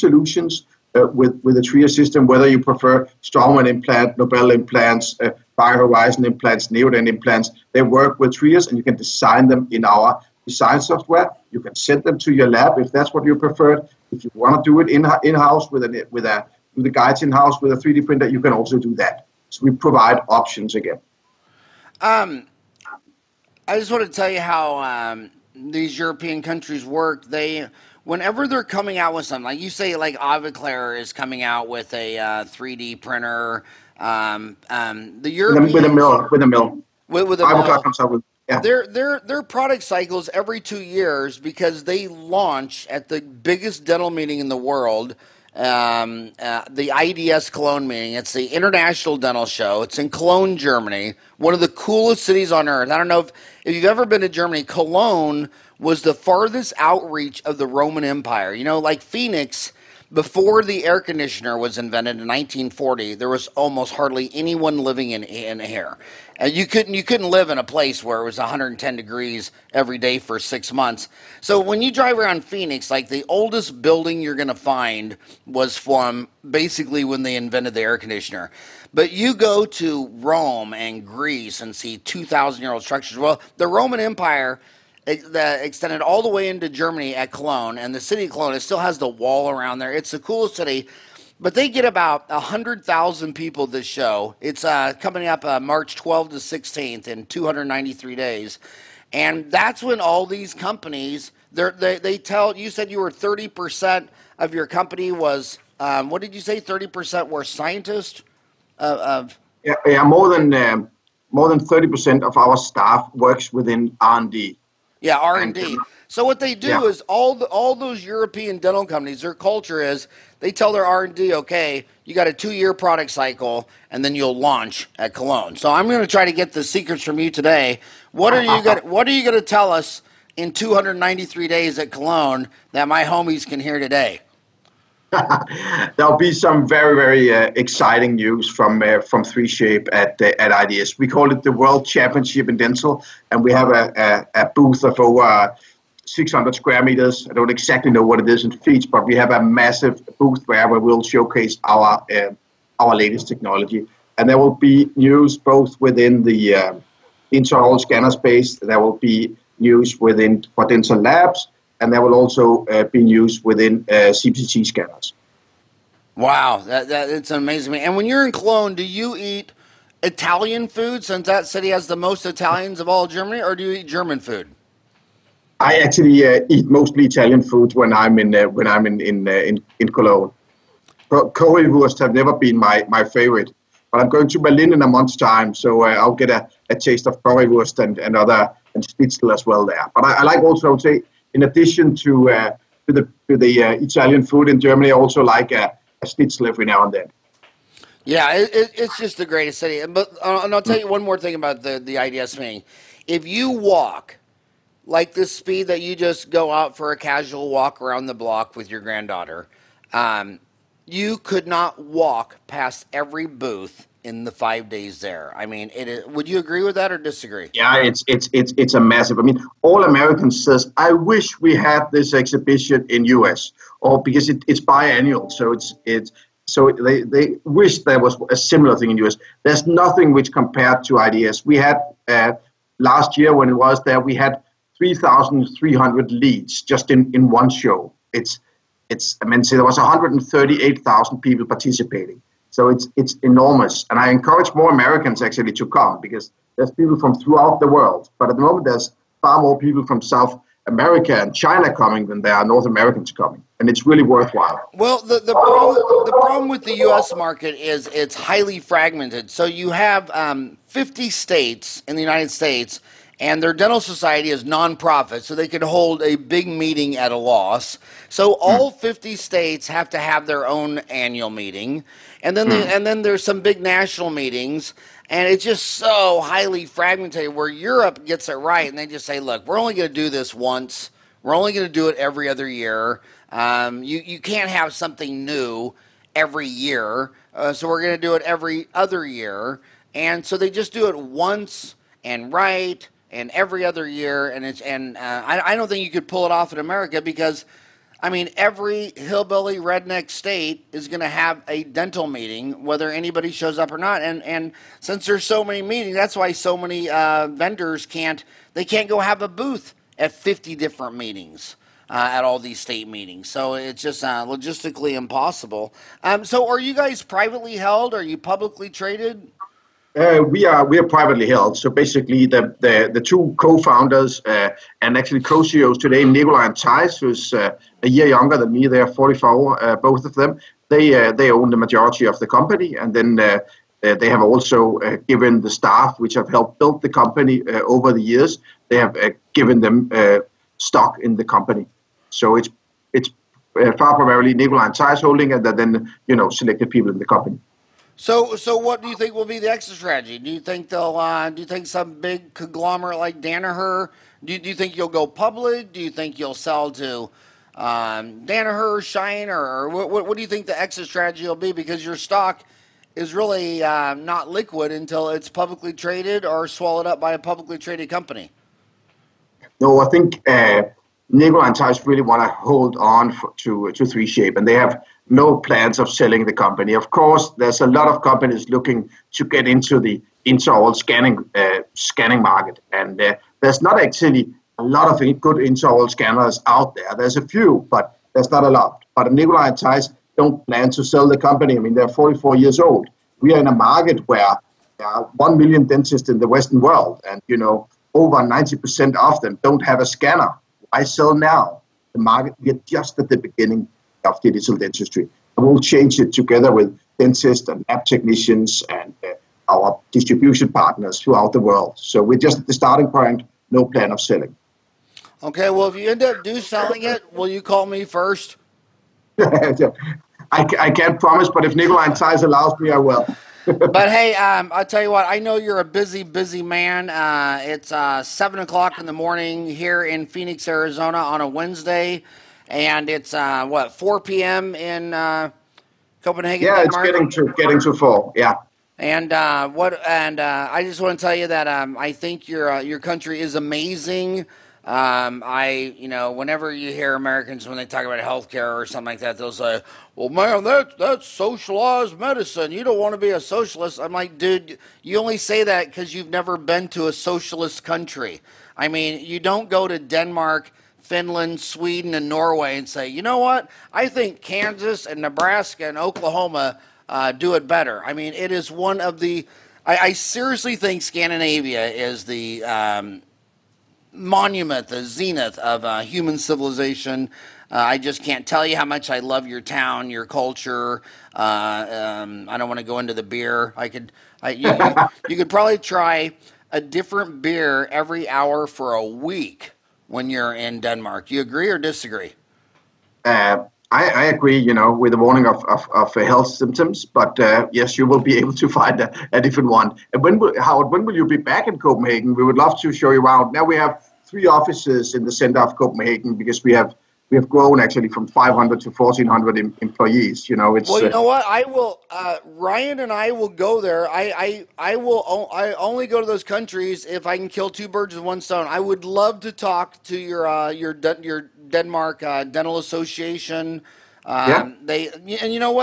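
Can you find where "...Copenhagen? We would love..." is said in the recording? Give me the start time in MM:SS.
08:21.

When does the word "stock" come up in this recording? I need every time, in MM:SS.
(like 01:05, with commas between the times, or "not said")
05:40, 06:01.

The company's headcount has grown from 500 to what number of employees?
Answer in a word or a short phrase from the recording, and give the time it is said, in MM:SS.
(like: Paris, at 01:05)
1400, at 08:28.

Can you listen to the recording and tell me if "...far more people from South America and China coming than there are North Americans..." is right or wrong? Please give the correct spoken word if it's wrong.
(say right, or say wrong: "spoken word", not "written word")
right.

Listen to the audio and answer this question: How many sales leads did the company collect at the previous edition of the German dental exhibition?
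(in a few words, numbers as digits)
3,300.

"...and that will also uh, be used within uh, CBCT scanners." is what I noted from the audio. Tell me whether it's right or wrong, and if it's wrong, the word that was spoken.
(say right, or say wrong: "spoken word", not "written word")
right.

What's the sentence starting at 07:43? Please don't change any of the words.
I think Kansas and Nebraska and Oklahoma uh, do it better.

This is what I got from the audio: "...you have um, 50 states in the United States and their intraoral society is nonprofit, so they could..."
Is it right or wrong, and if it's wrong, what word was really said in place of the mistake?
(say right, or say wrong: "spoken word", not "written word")
wrong: "dental", not "intraoral".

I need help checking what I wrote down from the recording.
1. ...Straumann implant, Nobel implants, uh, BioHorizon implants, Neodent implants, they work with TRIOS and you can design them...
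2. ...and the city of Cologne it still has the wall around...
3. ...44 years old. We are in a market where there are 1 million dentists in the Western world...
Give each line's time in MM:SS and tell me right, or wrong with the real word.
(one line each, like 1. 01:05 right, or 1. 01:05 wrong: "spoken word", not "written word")
1. 00:03 right
2. 01:27 right
3. 06:31 right.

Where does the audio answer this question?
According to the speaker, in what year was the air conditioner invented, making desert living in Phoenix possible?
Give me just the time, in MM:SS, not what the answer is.
01:02.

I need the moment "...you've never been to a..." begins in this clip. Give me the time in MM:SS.
07:35.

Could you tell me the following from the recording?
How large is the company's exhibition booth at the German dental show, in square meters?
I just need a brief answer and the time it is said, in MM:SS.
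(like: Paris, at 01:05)
over 600, at 02:24.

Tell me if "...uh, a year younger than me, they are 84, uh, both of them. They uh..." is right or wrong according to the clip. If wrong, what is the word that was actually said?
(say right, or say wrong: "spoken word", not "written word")
wrong: "44", not "84".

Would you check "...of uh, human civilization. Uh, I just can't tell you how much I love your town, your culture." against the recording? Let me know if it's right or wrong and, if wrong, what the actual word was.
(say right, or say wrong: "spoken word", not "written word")
right.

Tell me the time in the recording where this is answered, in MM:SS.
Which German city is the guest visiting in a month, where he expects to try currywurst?
03:04.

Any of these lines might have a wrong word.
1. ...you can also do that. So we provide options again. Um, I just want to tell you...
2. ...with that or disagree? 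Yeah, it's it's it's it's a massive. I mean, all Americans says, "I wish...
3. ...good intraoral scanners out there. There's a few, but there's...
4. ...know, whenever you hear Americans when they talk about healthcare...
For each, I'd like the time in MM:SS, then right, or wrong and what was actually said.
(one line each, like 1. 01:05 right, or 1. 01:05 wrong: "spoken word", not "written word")
1. 00:18 right
2. 03:36 right
3. 06:25 right
4. 07:25 right.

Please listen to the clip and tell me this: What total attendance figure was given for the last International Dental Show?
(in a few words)
138,000.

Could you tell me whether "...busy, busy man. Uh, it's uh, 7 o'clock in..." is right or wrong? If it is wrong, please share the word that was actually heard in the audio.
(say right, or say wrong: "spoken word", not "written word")
right.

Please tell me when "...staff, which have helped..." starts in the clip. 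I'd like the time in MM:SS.
05:35.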